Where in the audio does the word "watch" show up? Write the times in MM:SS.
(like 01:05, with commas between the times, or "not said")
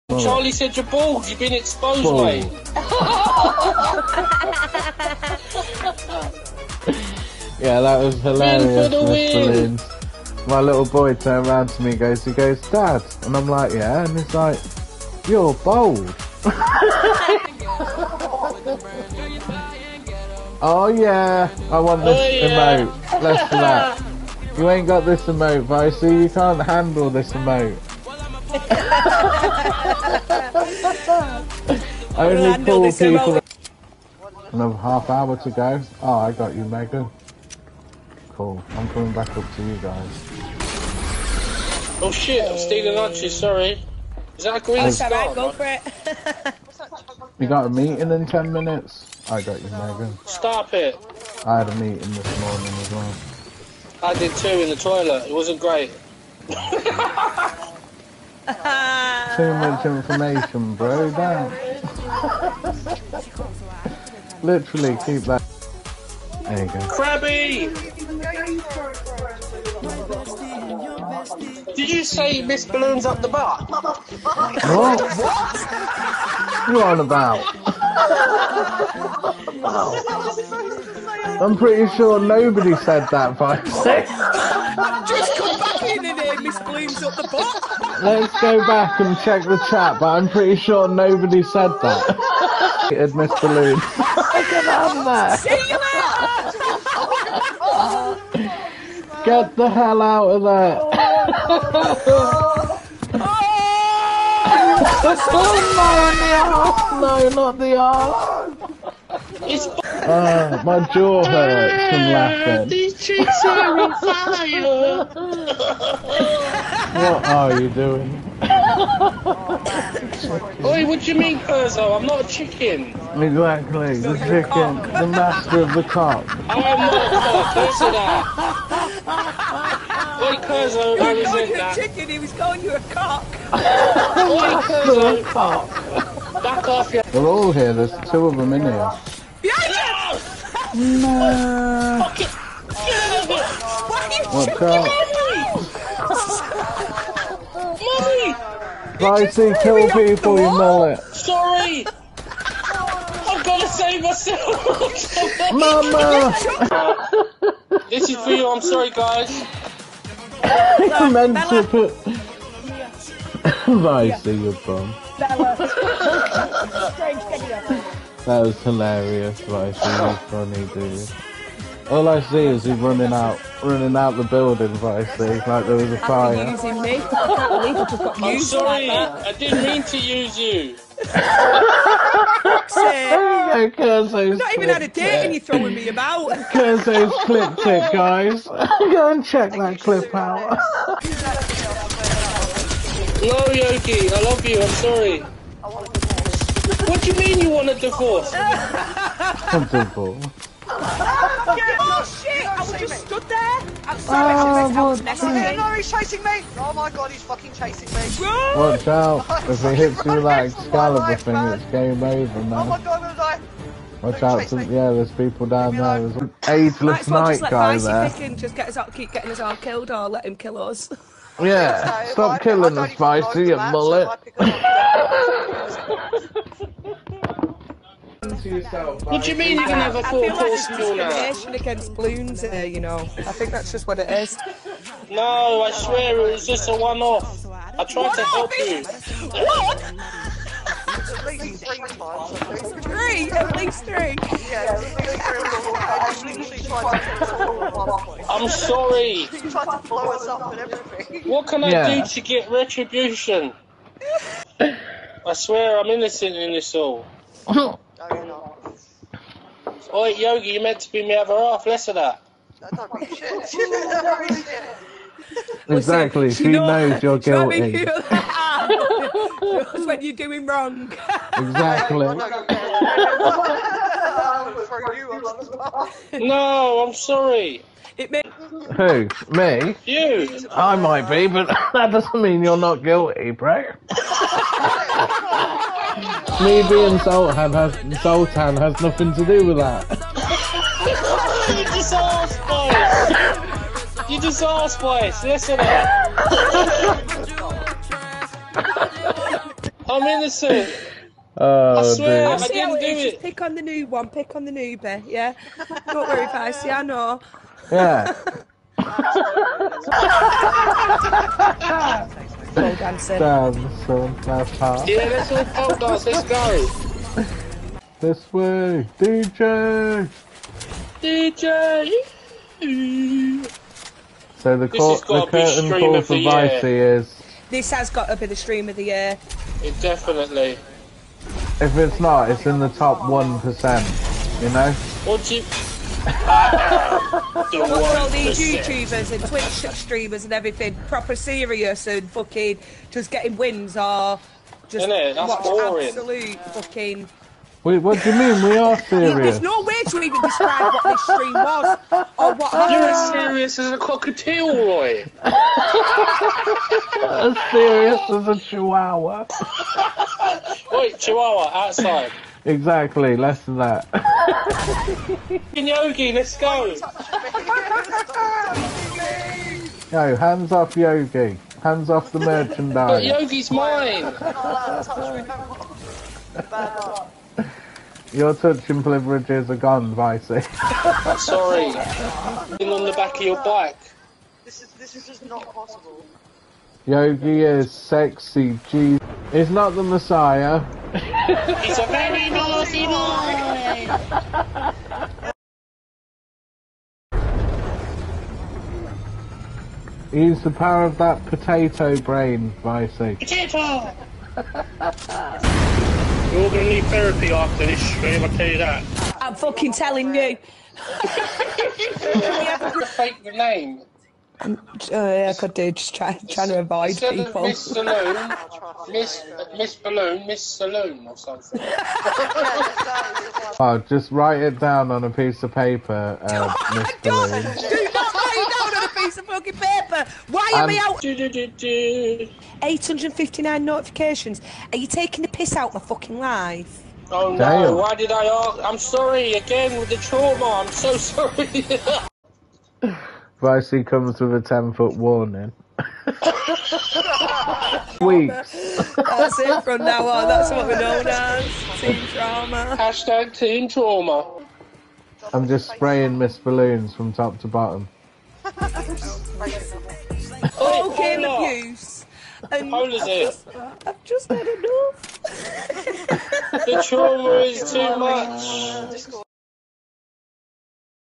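03:28, 03:34, 05:44.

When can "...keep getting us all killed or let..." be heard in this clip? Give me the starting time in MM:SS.
03:38.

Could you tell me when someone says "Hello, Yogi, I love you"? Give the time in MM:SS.
03:13.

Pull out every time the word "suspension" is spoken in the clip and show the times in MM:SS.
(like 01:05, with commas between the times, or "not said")
not said.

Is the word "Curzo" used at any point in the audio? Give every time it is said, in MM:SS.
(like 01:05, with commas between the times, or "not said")
02:01, 02:10, 02:14.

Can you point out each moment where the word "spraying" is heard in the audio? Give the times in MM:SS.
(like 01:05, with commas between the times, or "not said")
07:35.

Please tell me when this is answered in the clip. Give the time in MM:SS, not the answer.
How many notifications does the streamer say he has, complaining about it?
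07:12.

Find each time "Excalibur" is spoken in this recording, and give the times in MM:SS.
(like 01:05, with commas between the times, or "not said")
03:30.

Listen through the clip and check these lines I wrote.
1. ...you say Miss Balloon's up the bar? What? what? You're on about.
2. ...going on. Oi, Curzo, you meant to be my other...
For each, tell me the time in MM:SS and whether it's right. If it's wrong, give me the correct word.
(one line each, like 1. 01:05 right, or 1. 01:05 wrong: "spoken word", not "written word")
1. 01:11 right
2. 04:18 wrong: "Yogi", not "Curzo".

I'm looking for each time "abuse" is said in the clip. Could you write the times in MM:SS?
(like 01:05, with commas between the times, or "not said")
07:41.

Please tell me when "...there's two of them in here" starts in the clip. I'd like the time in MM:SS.
02:17.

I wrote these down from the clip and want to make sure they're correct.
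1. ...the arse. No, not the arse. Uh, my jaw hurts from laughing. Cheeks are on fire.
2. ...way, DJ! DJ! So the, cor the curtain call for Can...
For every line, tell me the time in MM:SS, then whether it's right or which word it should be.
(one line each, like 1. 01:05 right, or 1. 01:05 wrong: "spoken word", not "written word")
1. 01:47 right
2. 05:18 wrong: "Vicey", not "Can".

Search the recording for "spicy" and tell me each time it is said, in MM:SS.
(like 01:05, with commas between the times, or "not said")
03:42.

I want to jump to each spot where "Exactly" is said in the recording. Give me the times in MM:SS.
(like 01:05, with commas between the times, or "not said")
02:03, 04:25, 04:31, 06:02.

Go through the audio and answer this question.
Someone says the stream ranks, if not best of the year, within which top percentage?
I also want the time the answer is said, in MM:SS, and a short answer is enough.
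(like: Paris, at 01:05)
Top 1%, at 05:32.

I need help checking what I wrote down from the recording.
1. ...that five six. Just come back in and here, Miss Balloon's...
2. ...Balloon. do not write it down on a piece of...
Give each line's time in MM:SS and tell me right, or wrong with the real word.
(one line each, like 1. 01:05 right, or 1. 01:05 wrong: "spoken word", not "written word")
1. 01:23 right
2. 07:07 right.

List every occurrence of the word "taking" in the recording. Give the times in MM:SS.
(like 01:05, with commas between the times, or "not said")
07:14.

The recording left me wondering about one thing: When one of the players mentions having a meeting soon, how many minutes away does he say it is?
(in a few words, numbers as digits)
10.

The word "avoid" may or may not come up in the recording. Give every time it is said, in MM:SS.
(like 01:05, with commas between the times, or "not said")
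06:56.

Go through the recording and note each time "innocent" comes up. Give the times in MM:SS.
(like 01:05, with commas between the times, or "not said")
04:15, 05:00.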